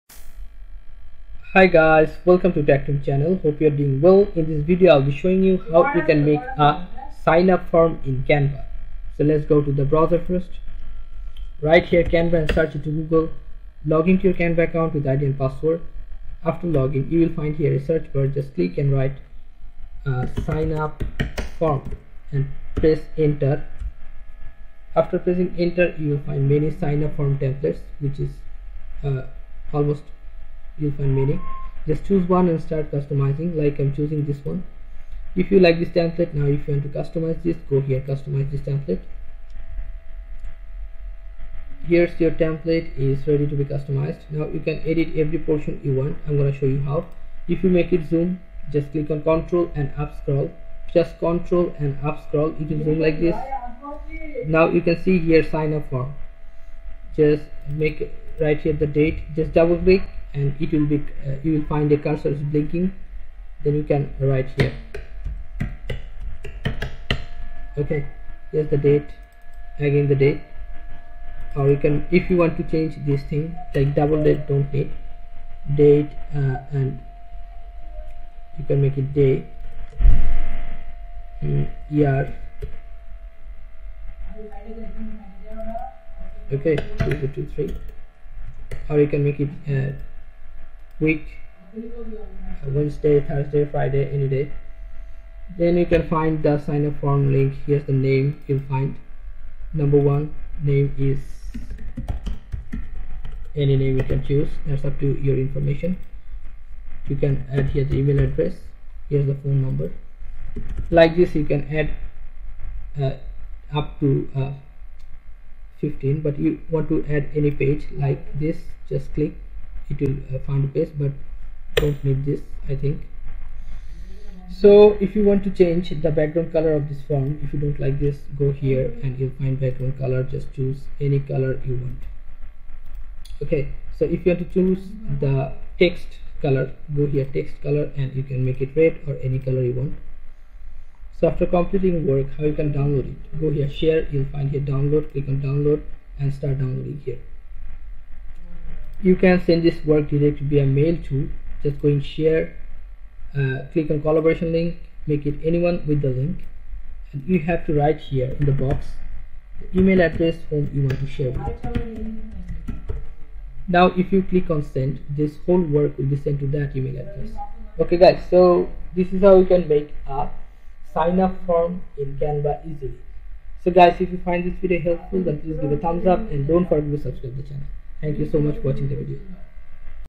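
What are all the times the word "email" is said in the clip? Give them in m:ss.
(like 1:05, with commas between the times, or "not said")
1:47, 2:39, 2:46.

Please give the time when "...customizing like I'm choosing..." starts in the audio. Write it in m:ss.
0:32.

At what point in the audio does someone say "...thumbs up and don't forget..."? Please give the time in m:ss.
2:55.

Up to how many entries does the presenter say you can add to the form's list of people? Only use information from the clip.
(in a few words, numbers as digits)
15.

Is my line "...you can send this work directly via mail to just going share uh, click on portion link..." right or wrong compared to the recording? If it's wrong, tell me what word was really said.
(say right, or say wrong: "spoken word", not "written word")
wrong: "collaboration", not "portion".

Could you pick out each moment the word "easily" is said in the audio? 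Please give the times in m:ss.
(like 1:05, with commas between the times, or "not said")
2:52.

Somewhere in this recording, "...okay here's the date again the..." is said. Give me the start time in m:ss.
1:07.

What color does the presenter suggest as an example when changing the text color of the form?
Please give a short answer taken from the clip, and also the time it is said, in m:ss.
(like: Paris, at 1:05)
red, at 2:18.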